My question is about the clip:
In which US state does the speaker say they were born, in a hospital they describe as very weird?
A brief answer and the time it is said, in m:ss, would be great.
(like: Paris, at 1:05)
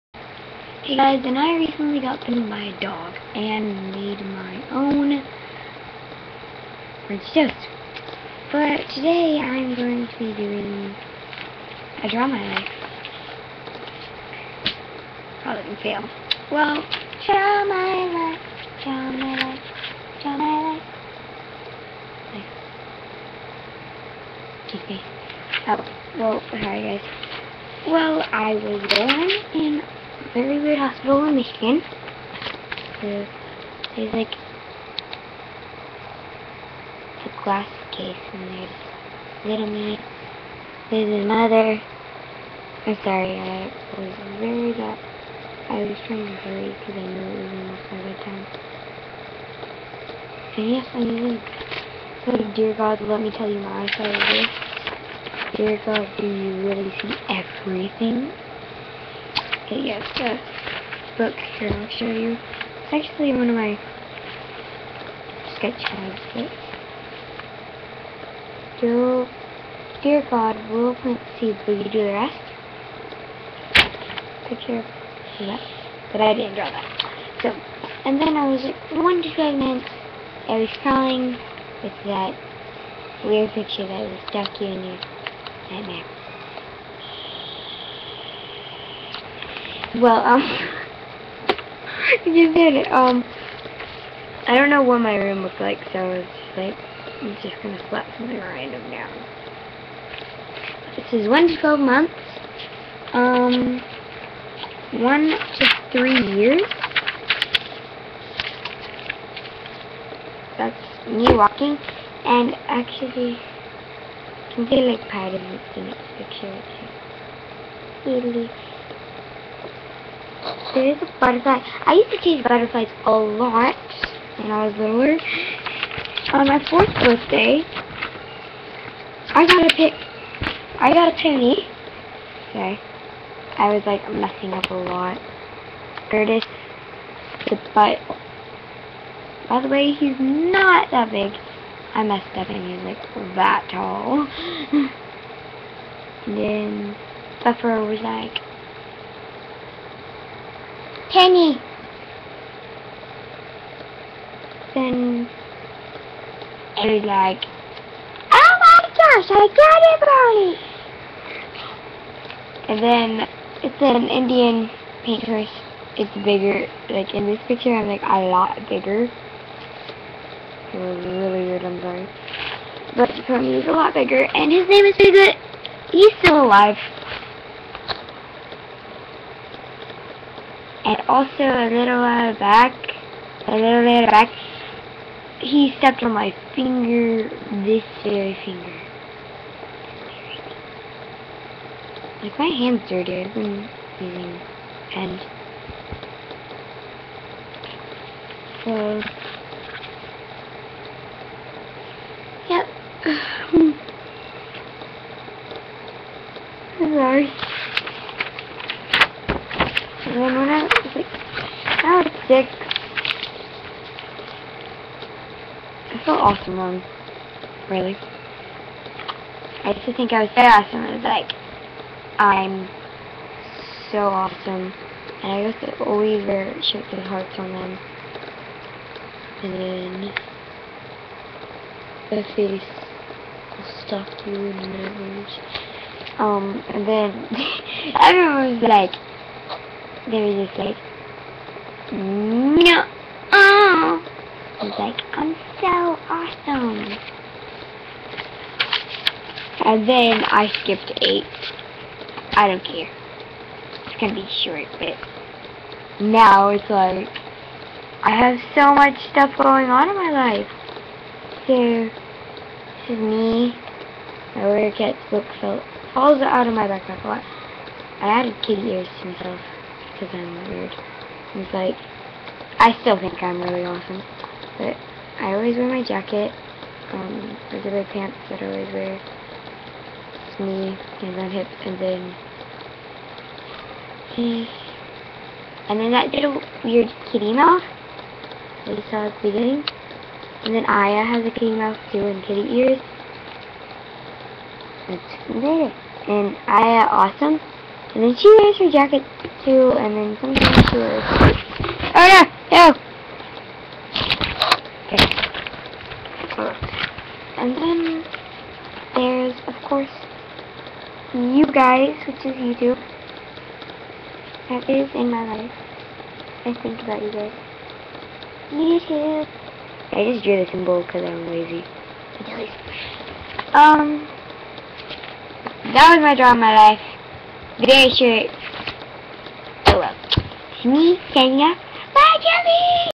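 Michigan, at 0:31.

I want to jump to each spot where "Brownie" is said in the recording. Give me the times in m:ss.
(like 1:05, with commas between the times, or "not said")
2:42.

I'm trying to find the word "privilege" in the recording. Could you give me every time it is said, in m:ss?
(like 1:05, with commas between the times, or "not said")
not said.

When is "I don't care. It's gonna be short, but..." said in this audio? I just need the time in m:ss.
4:12.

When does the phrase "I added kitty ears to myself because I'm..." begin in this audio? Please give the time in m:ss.
4:28.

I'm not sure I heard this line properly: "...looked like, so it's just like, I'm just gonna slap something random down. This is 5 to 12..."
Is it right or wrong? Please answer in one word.
wrong.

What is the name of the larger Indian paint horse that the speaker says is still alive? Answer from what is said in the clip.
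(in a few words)
Bigfoot.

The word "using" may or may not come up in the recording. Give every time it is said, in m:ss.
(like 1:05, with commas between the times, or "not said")
0:51, 3:13.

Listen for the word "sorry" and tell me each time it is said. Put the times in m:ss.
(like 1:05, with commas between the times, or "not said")
0:26, 0:43, 2:51.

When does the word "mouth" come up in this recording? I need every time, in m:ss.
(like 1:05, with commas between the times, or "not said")
4:47, 4:51.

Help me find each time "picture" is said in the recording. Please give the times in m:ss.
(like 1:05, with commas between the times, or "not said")
1:14, 1:23, 1:56, 2:47.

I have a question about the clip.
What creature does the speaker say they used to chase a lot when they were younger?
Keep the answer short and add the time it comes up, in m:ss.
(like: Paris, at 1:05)
Butterflies, at 2:02.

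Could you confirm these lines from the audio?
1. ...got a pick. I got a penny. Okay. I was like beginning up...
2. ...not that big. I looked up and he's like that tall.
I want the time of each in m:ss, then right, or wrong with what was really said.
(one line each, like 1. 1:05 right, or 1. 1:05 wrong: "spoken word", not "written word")
1. 2:09 wrong: "messing", not "beginning"
2. 2:20 wrong: "messed", not "looked".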